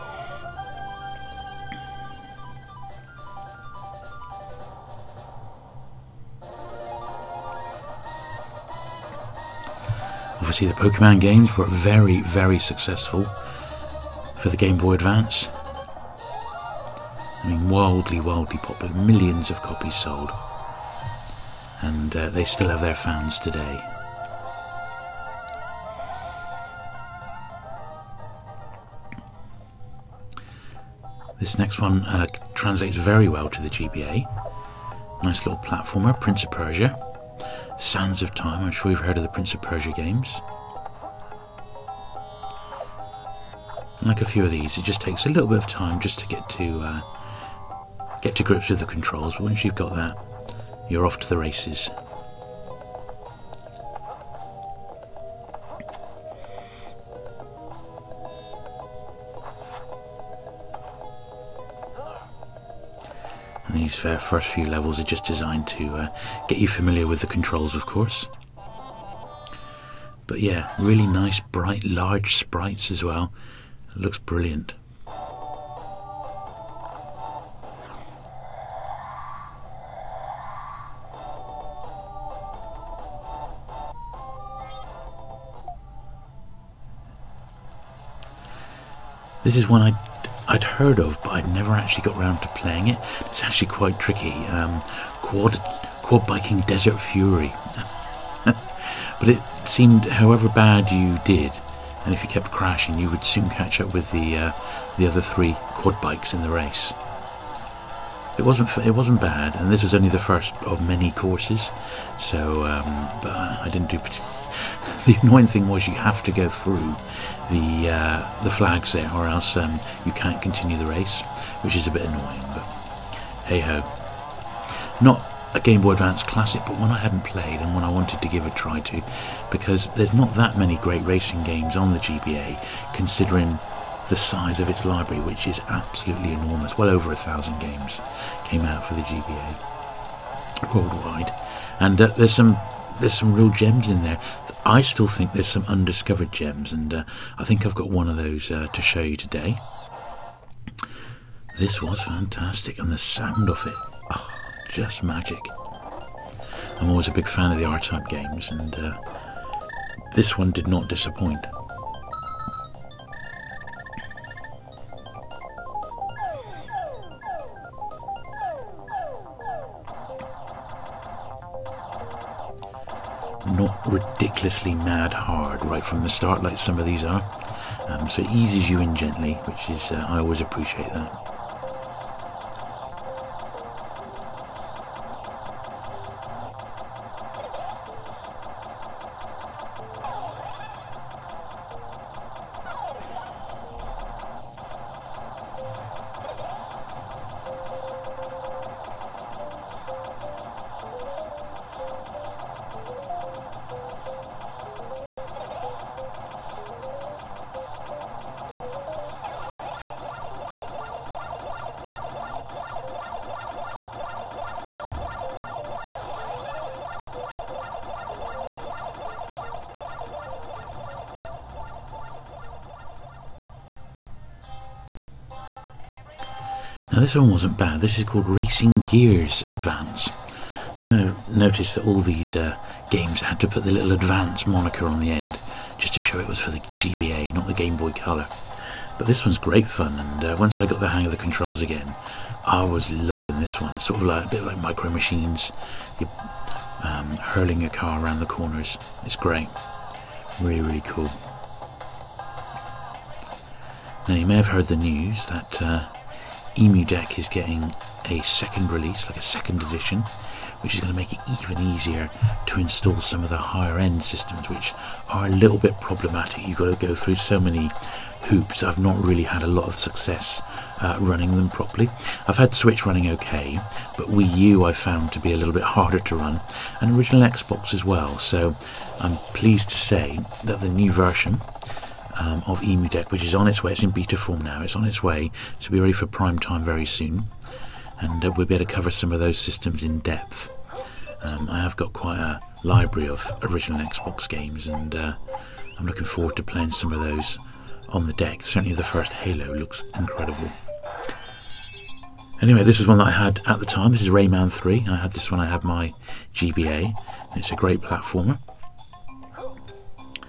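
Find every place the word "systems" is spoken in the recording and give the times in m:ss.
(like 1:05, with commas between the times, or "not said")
4:24, 4:49.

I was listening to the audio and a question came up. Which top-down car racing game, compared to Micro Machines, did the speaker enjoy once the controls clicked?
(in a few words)
Racing Gears Advance.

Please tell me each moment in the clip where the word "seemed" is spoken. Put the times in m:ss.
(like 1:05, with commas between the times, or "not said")
1:39.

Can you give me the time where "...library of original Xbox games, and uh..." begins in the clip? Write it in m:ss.
4:52.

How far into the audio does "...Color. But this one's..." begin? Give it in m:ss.
3:57.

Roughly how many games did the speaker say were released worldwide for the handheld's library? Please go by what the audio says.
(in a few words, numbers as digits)
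Well over 1000.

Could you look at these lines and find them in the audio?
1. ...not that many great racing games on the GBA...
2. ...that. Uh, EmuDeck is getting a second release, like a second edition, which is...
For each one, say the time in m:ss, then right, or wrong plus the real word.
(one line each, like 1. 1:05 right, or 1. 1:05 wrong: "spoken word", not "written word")
1. 2:10 right
2. 4:15 right.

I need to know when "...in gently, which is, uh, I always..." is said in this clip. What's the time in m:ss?
2:58.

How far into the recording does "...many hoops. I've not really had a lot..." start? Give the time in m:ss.
4:27.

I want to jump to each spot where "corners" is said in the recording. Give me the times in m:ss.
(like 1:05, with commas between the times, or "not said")
4:08.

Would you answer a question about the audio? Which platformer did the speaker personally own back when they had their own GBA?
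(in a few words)
Rayman 3.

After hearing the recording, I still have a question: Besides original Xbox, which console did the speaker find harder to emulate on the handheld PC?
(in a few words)
Wii U.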